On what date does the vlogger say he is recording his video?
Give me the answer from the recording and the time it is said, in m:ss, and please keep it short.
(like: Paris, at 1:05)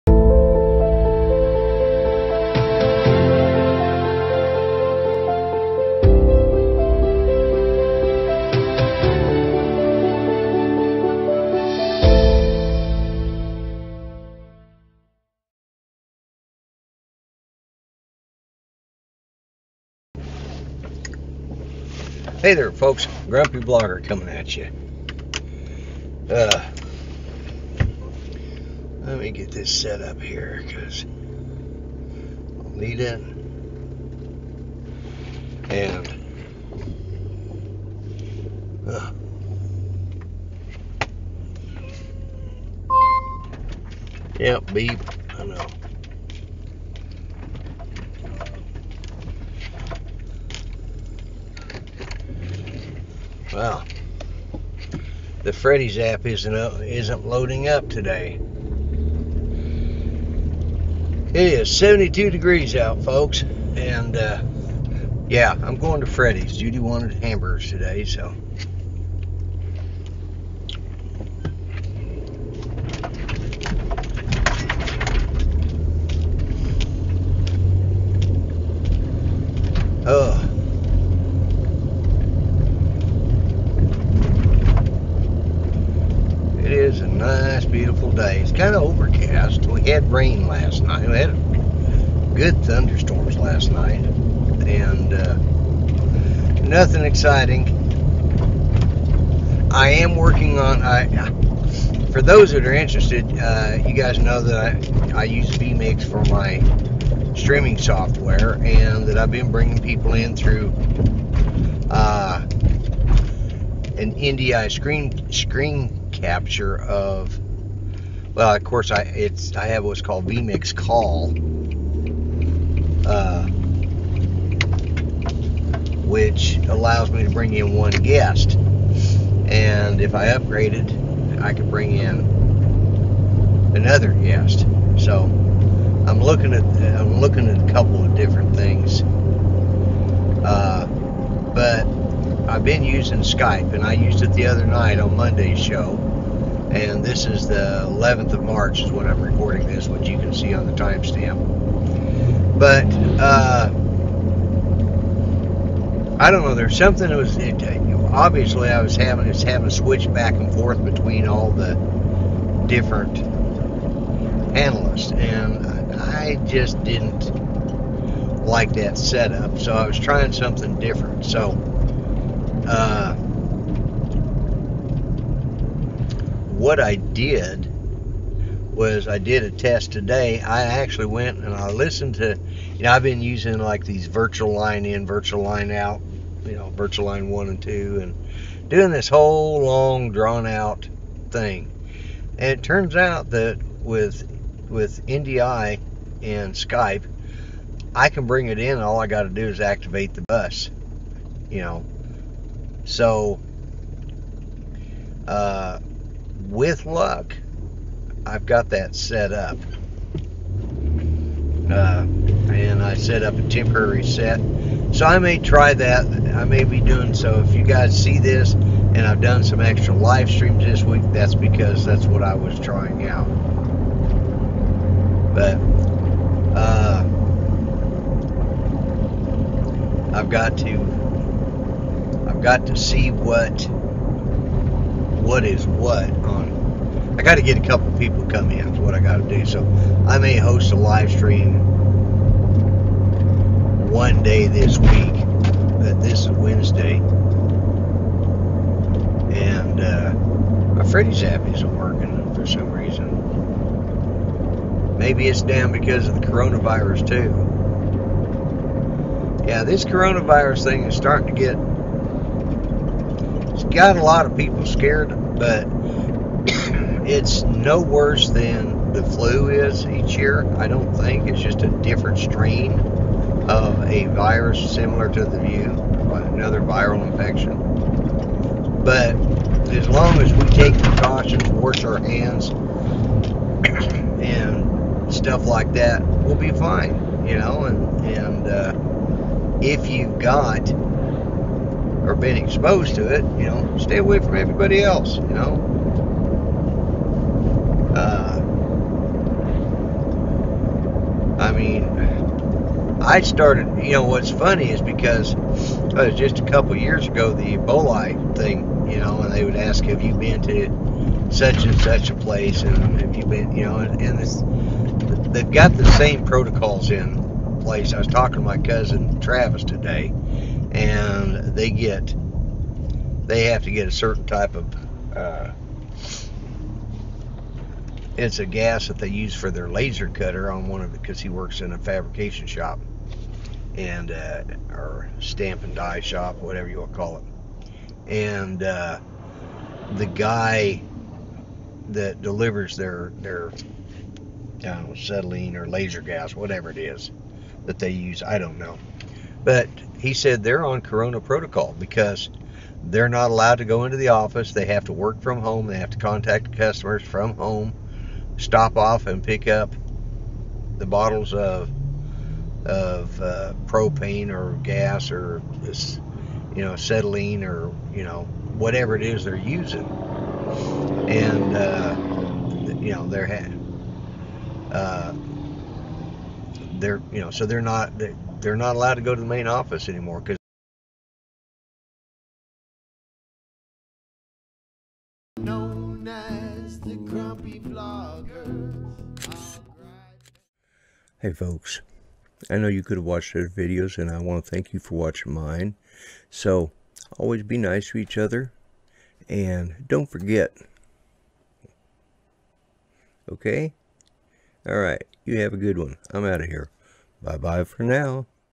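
March 11, at 2:27.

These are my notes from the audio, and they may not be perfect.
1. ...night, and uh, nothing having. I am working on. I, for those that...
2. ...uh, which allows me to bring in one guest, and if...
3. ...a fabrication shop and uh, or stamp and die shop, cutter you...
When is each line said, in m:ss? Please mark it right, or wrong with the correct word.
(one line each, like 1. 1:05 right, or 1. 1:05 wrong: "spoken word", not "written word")
1. 1:33 wrong: "exciting", not "having"
2. 2:03 right
3. 5:31 wrong: "whatever", not "cutter".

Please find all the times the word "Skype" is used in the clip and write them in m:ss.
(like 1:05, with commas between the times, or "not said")
2:23, 3:16.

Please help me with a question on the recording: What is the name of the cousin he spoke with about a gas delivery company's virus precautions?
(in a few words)
Travis.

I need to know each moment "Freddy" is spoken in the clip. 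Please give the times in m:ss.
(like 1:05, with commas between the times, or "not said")
0:55, 1:06, 4:10.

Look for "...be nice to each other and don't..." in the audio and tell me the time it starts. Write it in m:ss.
6:37.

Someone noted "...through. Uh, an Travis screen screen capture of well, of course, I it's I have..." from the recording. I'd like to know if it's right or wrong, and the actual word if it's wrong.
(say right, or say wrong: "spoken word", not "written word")
wrong: "NDI", not "Travis".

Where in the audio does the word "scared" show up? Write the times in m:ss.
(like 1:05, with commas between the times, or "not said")
4:24.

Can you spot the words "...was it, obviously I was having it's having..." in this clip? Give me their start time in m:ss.
2:37.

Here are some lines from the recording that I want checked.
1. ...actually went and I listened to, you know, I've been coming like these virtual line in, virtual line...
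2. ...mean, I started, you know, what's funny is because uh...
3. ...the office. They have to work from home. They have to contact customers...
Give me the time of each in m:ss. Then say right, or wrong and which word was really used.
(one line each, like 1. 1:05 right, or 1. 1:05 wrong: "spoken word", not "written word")
1. 3:00 wrong: "using", not "coming"
2. 5:01 right
3. 5:53 right.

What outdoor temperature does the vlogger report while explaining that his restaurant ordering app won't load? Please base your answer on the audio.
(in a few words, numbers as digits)
72 degrees.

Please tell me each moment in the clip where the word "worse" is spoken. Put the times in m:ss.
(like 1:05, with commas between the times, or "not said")
4:27.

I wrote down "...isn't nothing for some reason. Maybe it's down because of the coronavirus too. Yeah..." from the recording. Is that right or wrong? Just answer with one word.
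wrong.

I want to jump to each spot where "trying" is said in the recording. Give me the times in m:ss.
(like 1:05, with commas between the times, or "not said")
2:49, 3:42.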